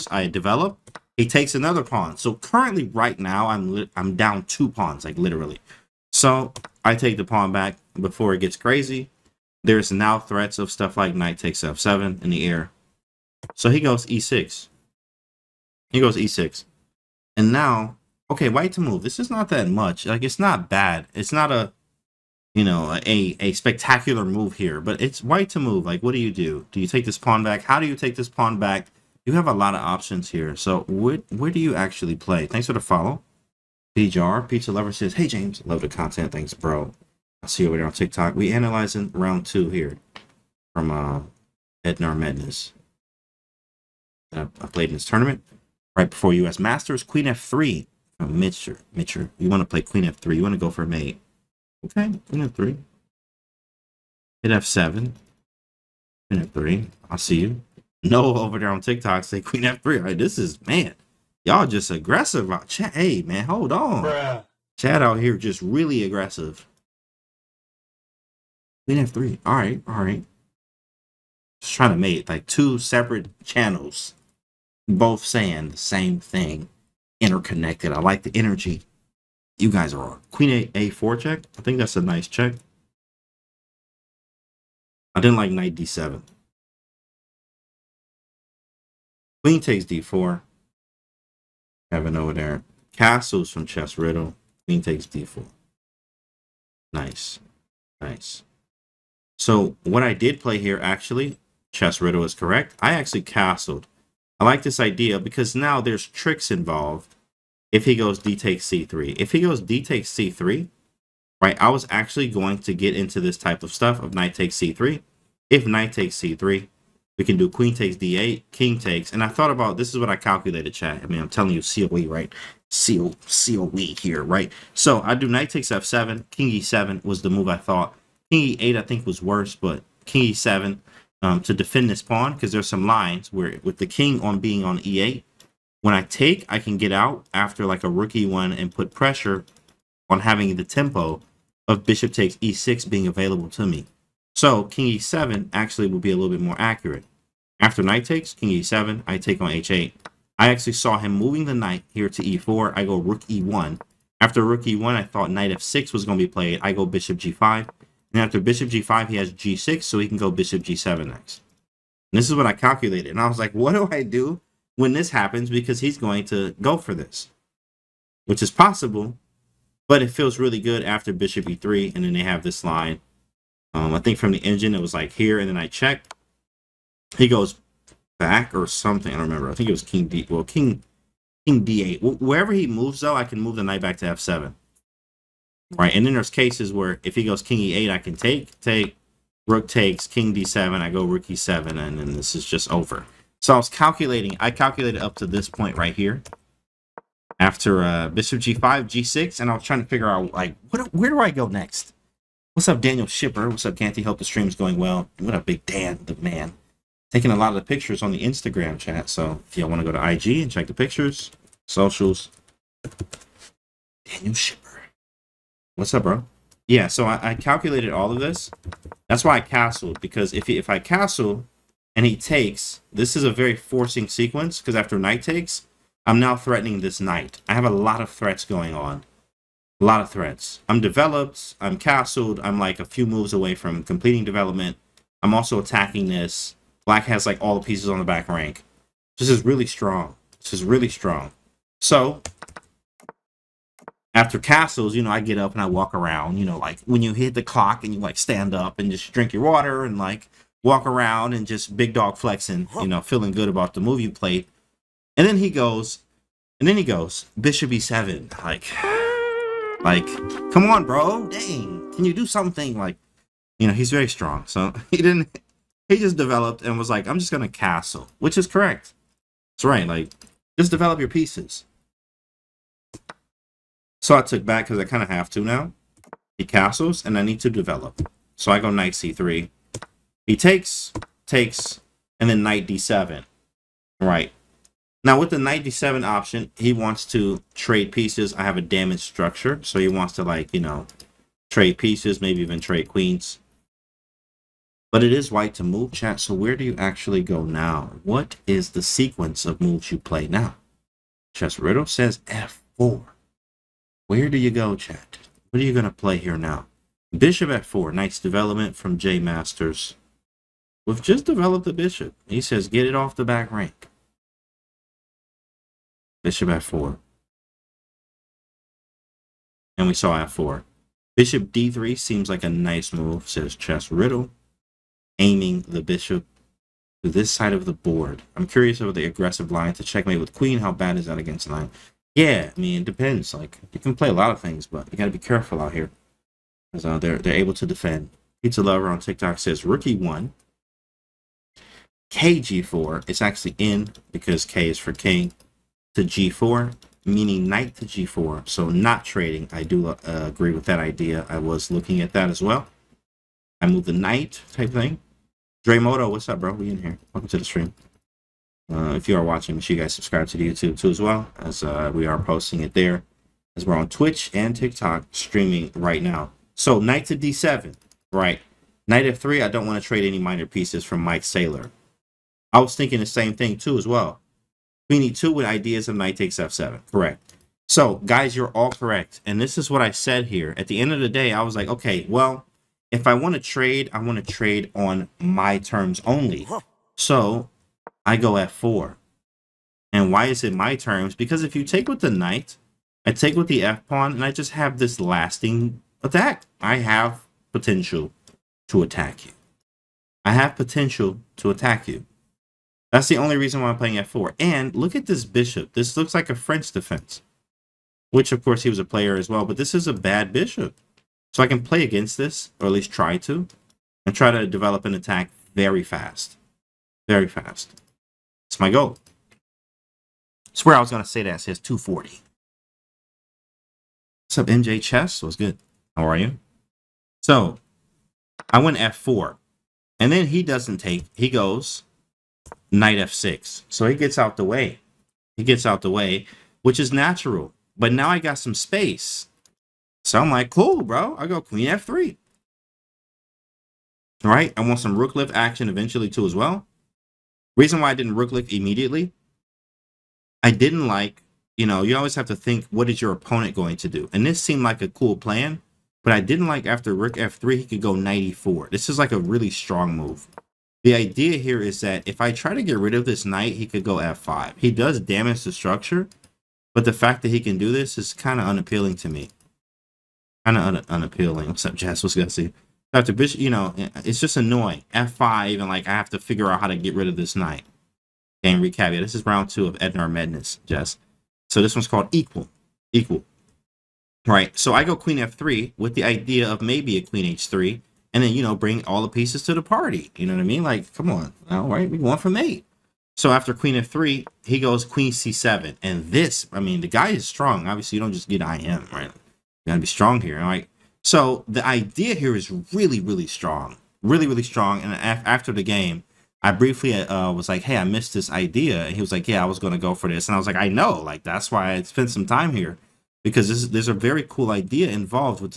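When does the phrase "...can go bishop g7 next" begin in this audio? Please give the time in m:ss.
2:40.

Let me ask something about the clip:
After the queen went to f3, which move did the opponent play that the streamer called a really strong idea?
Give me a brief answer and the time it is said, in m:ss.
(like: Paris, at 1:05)
Queen c7, at 8:14.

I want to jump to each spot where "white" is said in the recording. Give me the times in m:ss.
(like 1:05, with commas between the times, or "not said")
0:18, 0:25, 4:55.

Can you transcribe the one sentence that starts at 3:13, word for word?
So I was calculating, I calculated up to this point right here.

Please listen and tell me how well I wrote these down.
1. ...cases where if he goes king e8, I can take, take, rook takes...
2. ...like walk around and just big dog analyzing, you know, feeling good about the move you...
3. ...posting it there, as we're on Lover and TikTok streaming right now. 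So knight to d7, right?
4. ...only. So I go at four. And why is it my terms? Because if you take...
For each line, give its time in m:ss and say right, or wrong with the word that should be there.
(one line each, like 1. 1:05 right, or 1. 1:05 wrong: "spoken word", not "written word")
1. 3:06 right
2. 4:09 wrong: "flexing", not "analyzing"
3. 6:02 wrong: "Twitch", not "Lover"
4. 6:26 right.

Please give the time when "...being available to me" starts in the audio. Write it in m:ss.
2:22.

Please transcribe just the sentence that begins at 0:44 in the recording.
I played in this tournament right before US Masters, Queen F3.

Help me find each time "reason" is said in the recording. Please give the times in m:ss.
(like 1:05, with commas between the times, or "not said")
6:43, 7:27.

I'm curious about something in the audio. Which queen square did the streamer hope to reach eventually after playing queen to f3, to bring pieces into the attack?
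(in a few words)
h3.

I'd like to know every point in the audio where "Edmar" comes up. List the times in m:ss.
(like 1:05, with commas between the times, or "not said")
0:41, 7:59.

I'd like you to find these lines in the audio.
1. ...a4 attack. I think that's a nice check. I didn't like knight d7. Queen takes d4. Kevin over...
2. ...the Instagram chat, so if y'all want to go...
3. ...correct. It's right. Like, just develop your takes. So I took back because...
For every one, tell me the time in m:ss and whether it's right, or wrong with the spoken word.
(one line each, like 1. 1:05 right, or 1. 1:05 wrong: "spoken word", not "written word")
1. 1:20 wrong: "check", not "attack"
2. 3:28 right
3. 4:28 wrong: "pieces", not "takes".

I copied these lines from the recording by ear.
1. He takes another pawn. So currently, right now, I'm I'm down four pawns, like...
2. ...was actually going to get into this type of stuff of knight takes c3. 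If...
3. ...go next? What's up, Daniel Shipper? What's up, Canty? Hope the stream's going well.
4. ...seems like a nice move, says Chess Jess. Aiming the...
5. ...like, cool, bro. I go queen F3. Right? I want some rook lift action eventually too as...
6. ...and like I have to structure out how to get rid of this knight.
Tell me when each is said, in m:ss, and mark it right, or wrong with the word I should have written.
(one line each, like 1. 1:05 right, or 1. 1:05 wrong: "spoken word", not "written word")
1. 0:01 wrong: "two", not "four"
2. 1:51 right
3. 3:21 right
4. 5:21 wrong: "Riddle", not "Jess"
5. 7:20 right
6. 7:55 wrong: "figure", not "structure".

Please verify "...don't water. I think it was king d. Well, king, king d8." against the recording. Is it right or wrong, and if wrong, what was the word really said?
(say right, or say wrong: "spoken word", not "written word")
wrong: "remember", not "water".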